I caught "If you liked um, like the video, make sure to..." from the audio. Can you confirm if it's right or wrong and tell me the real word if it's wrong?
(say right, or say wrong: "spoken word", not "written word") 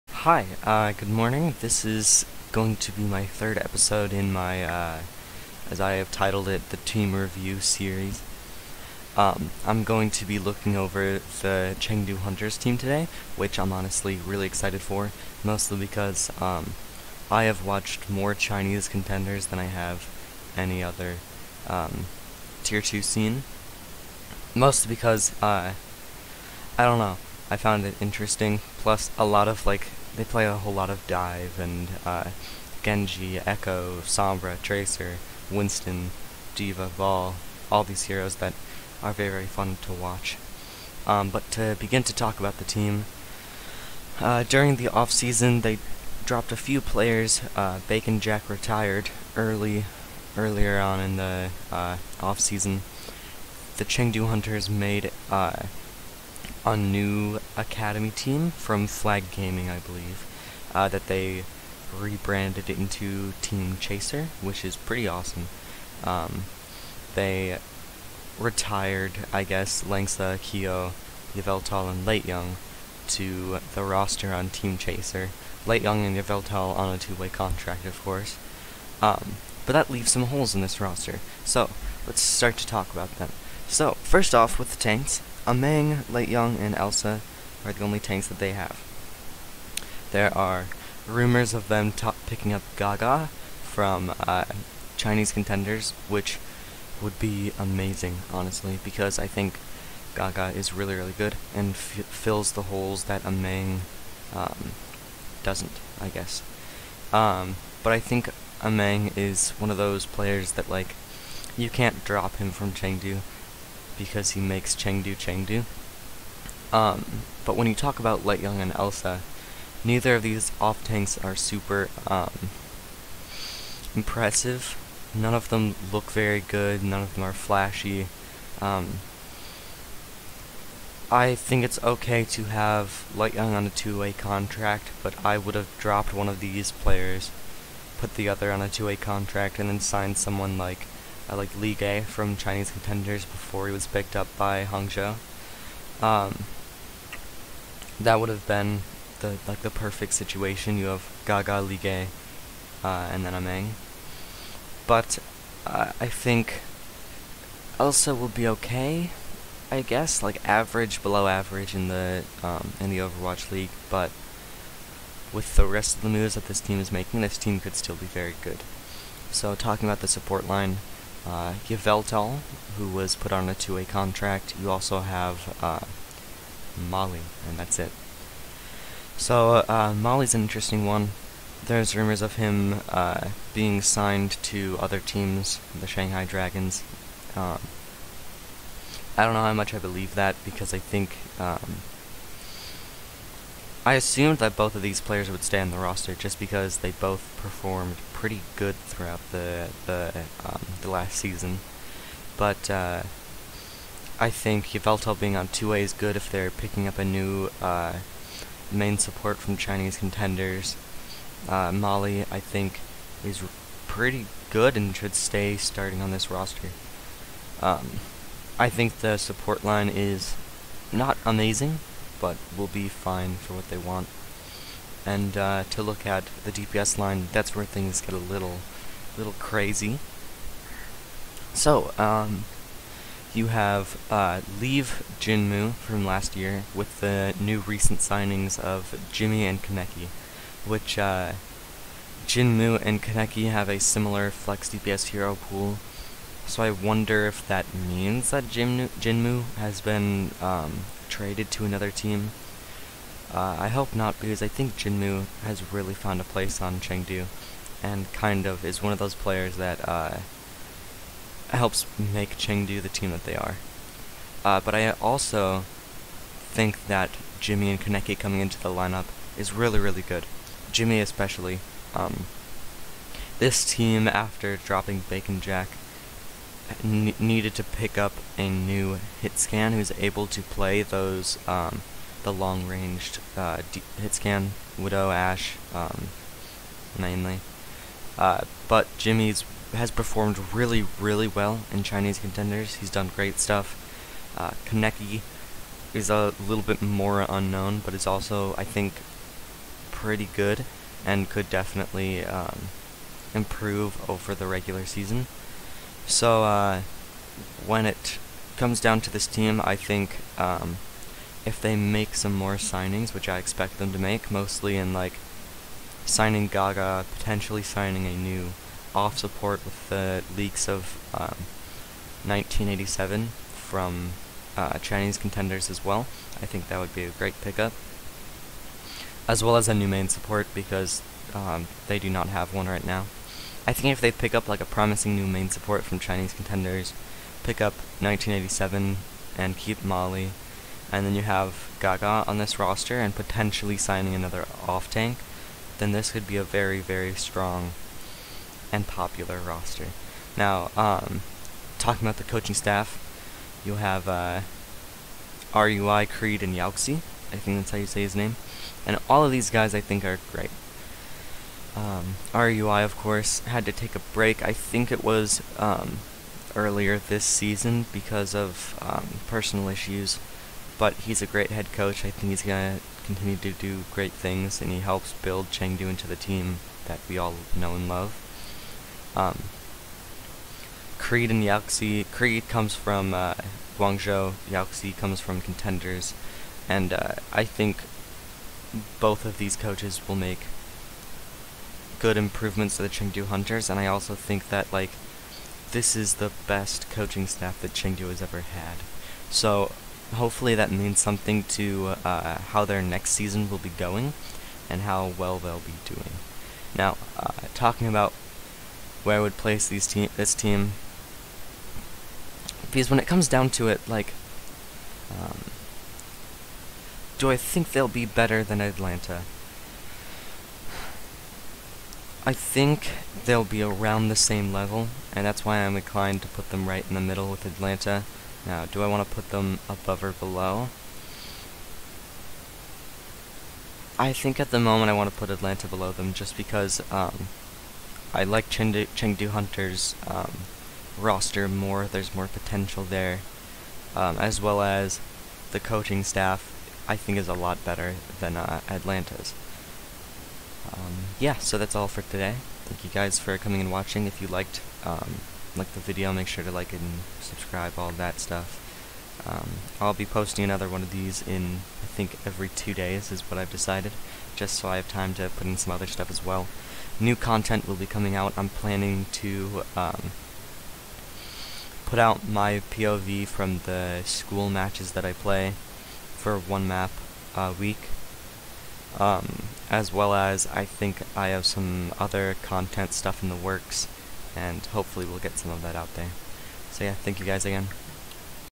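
right.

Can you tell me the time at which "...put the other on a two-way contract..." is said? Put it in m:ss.
2:17.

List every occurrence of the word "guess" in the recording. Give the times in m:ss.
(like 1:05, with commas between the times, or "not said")
1:09, 1:46, 2:39.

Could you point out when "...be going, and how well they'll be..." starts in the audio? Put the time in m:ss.
6:43.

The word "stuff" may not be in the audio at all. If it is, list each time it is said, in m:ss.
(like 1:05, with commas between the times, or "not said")
4:53, 7:38, 7:45, 8:02.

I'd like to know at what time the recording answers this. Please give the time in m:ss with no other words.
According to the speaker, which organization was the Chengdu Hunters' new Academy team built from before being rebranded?
0:58.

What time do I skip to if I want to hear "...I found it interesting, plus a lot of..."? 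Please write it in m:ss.
0:27.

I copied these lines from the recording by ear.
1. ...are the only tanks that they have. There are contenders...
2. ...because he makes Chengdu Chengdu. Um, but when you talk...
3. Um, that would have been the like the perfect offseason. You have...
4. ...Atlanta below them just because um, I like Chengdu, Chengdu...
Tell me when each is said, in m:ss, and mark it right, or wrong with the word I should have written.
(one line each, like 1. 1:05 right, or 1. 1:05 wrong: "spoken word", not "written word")
1. 1:27 wrong: "rumors", not "contenders"
2. 1:54 right
3. 2:26 wrong: "situation", not "offseason"
4. 7:15 right.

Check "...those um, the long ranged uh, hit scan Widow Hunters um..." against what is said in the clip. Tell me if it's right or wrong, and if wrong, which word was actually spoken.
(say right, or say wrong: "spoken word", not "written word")
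wrong: "Ash", not "Hunters".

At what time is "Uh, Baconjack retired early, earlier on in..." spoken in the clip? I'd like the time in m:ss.
0:47.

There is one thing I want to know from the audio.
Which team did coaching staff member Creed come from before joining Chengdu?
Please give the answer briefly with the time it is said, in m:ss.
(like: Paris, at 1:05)
Guangzhou, at 6:23.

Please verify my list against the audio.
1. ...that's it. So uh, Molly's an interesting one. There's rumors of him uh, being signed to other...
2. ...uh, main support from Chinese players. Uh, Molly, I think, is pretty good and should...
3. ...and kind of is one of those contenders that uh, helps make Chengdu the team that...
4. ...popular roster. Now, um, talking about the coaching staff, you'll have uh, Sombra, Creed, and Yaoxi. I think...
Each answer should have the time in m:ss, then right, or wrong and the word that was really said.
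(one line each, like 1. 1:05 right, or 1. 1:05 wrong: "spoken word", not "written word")
1. 2:57 right
2. 3:27 wrong: "contenders", not "players"
3. 4:17 wrong: "players", not "contenders"
4. 5:48 wrong: "RUI", not "Sombra".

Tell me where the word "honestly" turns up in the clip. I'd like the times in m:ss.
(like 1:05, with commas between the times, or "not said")
0:13, 1:38.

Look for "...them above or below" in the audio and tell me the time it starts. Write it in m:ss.
7:09.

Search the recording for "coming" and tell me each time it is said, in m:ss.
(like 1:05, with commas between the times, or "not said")
4:28, 7:33, 7:47.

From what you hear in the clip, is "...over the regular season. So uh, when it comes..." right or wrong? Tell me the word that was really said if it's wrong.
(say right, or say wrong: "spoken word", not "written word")
right.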